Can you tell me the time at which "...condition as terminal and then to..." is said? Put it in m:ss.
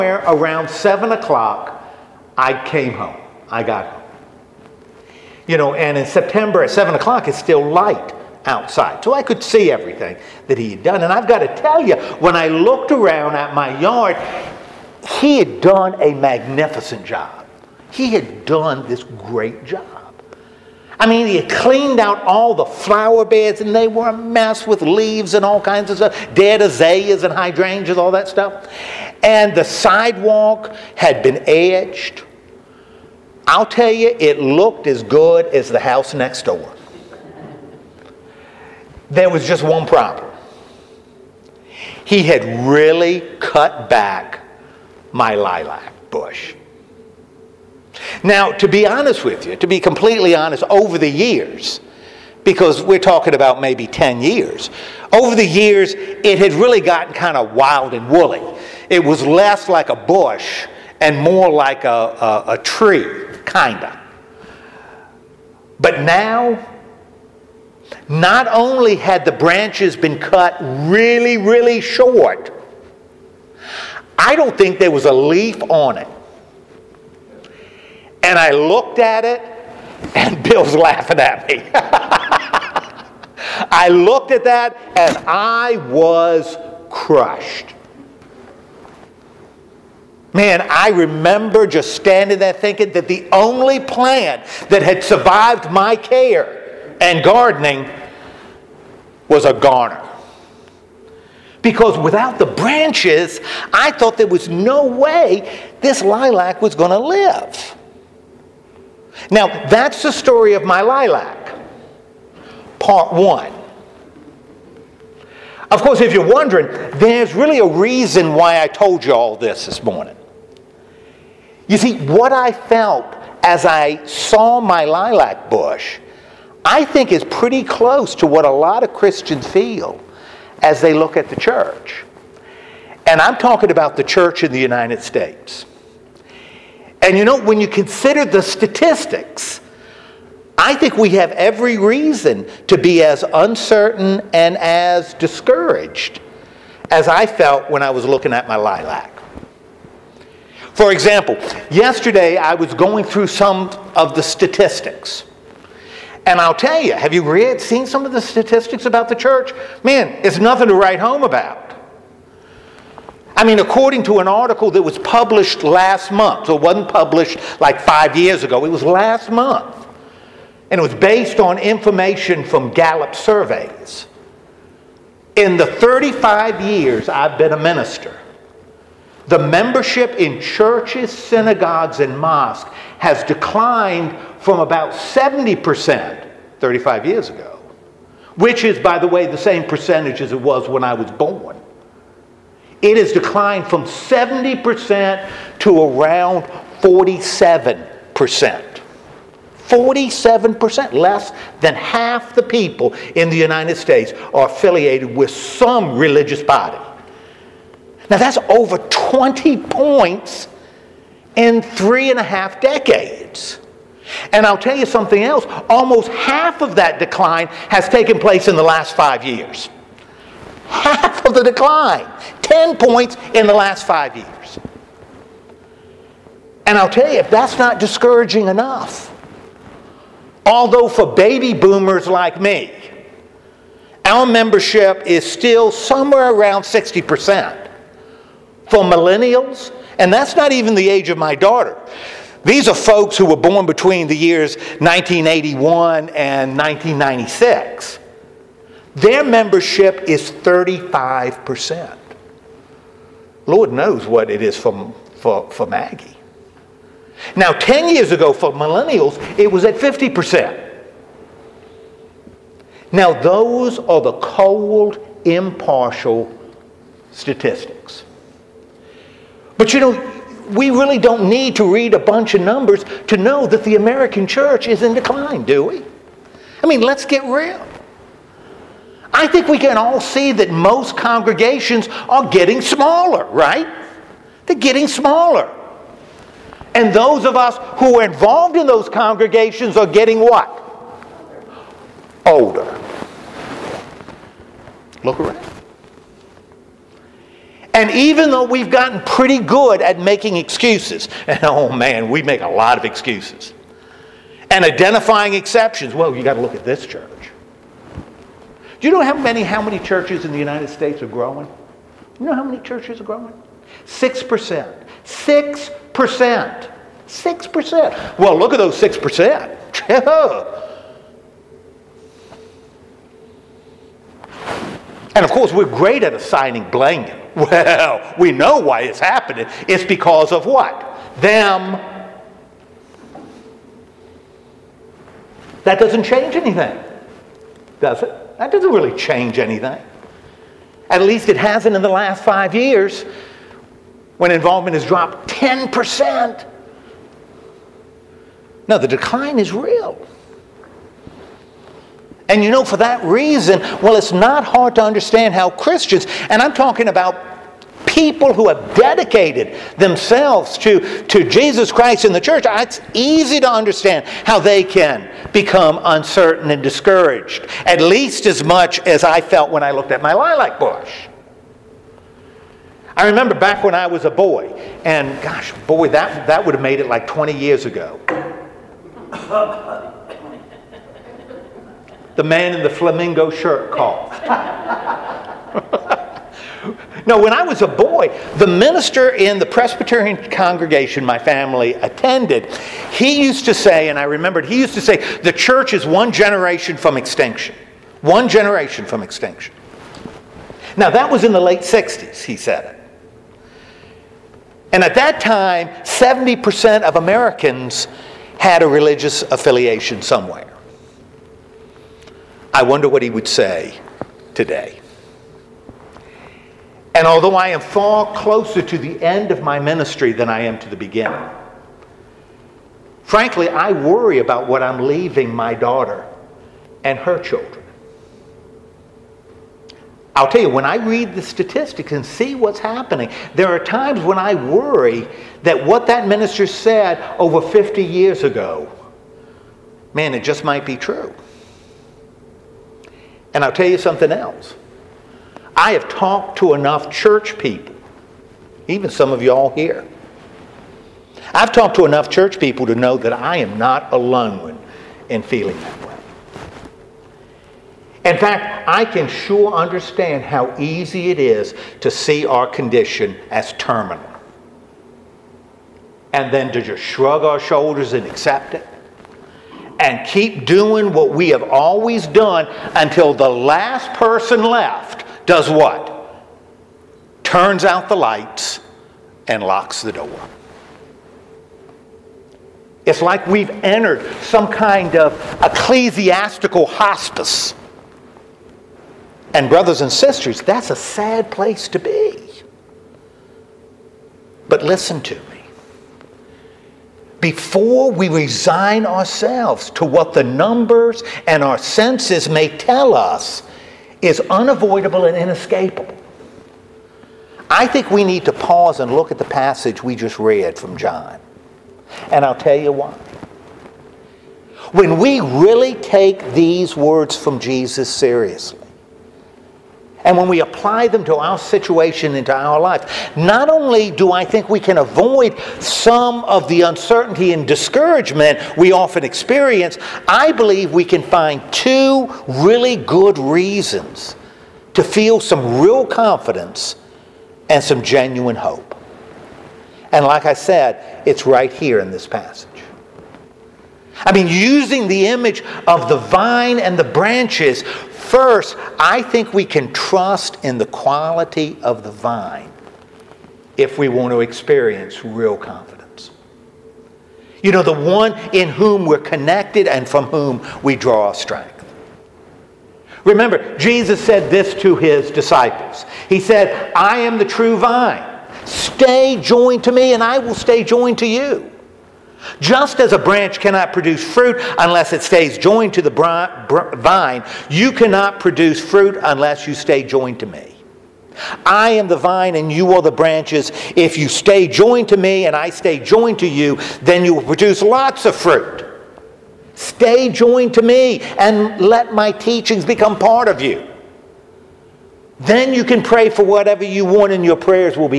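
7:42.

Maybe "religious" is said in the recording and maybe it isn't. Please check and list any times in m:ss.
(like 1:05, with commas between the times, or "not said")
3:25, 6:48.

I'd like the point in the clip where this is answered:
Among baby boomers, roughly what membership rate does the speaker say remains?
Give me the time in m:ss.
3:56.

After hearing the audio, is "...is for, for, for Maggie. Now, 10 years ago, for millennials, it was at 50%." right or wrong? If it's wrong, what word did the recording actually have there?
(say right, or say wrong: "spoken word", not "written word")
right.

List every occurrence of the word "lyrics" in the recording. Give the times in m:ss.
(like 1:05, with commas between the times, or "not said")
not said.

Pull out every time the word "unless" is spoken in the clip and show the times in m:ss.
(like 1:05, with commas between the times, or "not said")
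9:34, 9:39.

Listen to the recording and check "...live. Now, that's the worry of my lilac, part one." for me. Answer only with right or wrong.
wrong.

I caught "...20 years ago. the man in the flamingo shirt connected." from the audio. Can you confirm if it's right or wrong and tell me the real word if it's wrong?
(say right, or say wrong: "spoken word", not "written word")
wrong: "coughed", not "connected".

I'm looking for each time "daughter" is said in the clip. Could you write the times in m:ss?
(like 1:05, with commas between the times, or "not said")
4:01, 7:05.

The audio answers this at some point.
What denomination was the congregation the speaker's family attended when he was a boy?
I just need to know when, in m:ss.
6:29.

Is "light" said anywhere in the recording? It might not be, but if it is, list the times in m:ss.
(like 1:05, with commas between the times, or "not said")
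0:07, 7:57.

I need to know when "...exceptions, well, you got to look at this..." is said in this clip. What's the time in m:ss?
5:05.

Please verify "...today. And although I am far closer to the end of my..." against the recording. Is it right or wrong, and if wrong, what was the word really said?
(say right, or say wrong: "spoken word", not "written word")
right.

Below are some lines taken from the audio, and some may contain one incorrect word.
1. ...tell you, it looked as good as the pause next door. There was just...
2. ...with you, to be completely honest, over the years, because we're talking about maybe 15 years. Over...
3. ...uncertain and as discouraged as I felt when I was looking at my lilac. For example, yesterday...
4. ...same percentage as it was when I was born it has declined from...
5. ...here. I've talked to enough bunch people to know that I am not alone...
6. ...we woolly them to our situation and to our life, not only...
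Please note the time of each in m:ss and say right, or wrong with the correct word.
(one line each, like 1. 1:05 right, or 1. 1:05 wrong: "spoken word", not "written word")
1. 0:33 wrong: "house", not "pause"
2. 0:49 wrong: "10", not "15"
3. 2:23 right
4. 3:09 right
5. 7:29 wrong: "church", not "bunch"
6. 8:40 wrong: "apply", not "woolly".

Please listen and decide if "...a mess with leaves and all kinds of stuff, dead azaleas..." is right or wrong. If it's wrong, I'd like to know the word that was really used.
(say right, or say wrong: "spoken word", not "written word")
right.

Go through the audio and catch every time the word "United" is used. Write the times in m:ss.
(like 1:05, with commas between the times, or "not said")
2:14, 3:23, 5:10.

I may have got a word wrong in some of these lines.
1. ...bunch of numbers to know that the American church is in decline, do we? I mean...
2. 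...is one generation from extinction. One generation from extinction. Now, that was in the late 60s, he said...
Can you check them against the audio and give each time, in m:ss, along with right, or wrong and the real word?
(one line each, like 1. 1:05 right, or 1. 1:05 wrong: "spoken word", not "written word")
1. 4:31 right
2. 6:35 right.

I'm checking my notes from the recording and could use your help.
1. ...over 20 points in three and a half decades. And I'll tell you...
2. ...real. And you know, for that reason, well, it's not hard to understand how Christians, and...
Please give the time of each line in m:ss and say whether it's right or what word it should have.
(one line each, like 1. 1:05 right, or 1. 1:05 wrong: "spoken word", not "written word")
1. 3:28 right
2. 5:49 right.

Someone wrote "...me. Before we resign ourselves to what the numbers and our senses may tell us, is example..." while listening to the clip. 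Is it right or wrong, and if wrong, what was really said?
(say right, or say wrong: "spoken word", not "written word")
wrong: "unavoidable", not "example".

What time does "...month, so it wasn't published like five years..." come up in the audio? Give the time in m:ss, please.
2:46.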